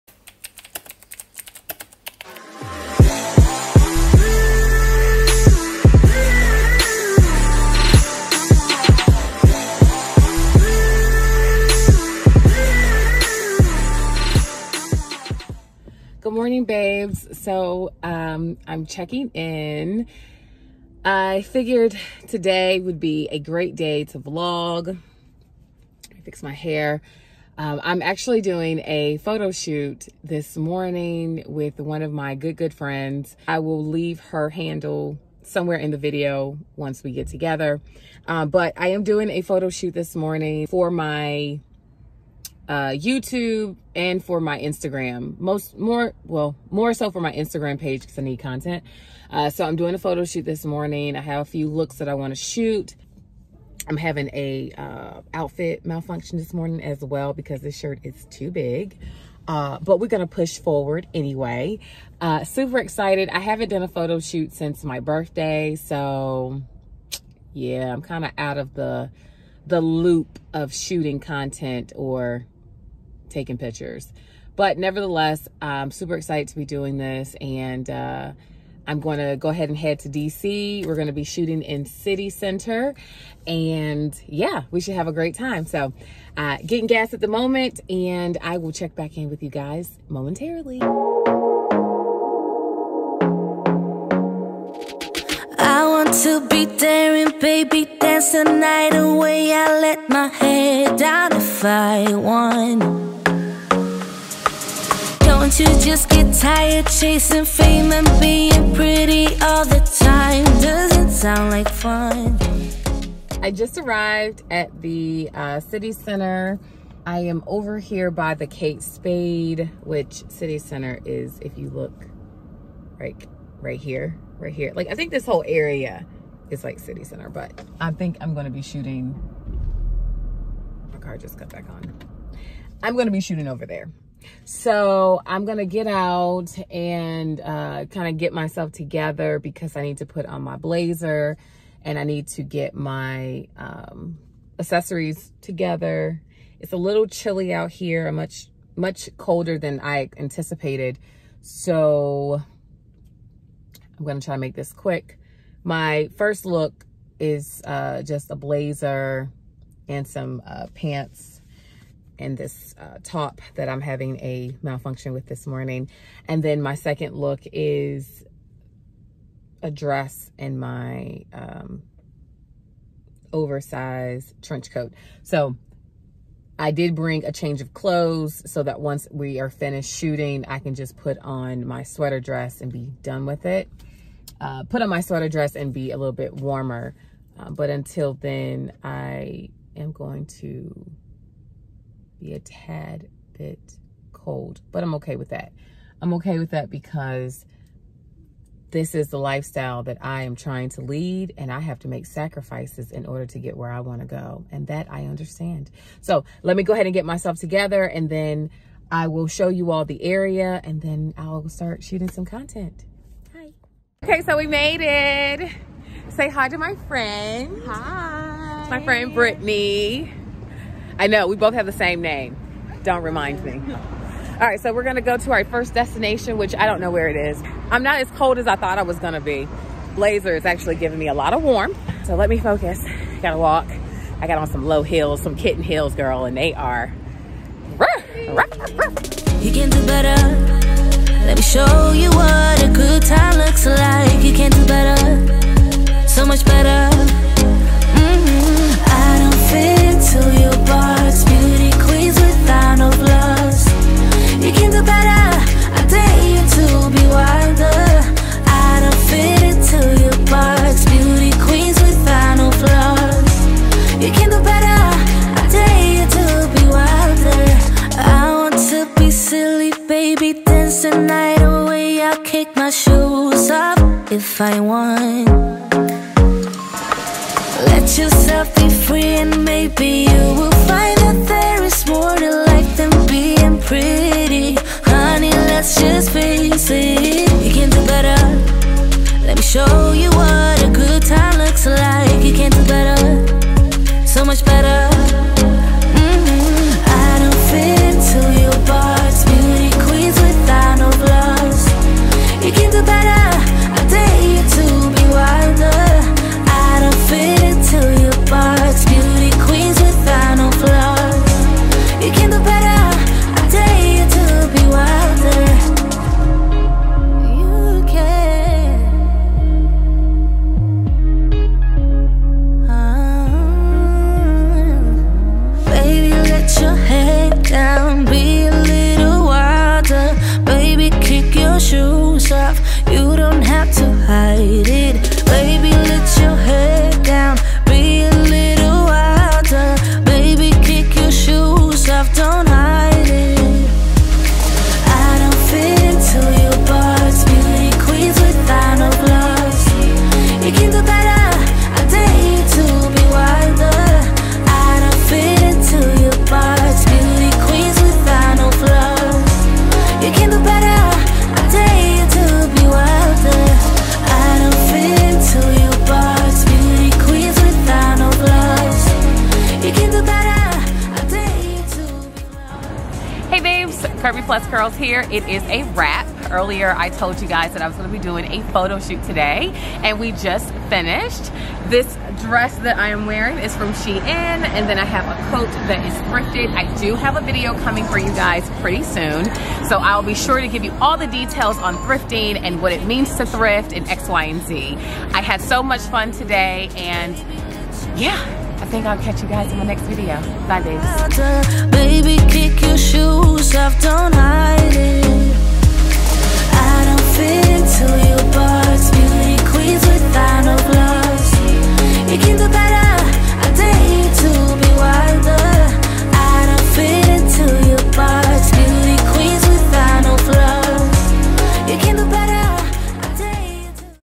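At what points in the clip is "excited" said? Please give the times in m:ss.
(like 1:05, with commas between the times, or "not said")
1:02, 1:16.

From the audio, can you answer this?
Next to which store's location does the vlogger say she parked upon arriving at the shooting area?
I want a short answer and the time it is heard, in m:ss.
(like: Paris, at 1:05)
Kate Spade, at 1:58.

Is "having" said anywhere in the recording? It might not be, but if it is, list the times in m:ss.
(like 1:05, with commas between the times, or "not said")
0:53, 2:43.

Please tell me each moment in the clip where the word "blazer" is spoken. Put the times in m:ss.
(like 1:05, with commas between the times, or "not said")
2:20, 2:38, 3:49.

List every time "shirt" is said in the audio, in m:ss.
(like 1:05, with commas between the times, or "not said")
0:57.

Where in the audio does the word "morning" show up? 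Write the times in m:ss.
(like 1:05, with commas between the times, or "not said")
0:16, 0:30, 0:40, 0:50, 0:56, 2:45.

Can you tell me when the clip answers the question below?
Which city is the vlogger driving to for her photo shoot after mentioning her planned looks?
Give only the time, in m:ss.
1:20.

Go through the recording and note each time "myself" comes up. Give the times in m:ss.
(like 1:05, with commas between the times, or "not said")
2:18, 3:27.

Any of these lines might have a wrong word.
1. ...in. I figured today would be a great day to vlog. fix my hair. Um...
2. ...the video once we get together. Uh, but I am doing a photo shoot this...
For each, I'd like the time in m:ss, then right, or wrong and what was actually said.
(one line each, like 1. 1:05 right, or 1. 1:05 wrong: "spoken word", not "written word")
1. 0:19 right
2. 0:35 right.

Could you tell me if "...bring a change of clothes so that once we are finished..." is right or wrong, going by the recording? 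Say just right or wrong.
right.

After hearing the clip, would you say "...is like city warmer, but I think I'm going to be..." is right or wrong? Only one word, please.
wrong.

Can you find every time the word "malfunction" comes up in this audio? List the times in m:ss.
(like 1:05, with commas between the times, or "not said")
0:55, 2:44.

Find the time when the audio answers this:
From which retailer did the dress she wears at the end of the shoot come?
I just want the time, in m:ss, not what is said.
6:23.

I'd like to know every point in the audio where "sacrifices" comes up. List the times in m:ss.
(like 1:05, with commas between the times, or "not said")
3:22.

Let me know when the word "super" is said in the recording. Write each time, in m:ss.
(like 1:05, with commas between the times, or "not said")
1:02, 1:15.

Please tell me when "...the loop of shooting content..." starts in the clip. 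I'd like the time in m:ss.
1:09.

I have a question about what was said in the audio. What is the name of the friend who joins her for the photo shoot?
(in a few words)
Brittany.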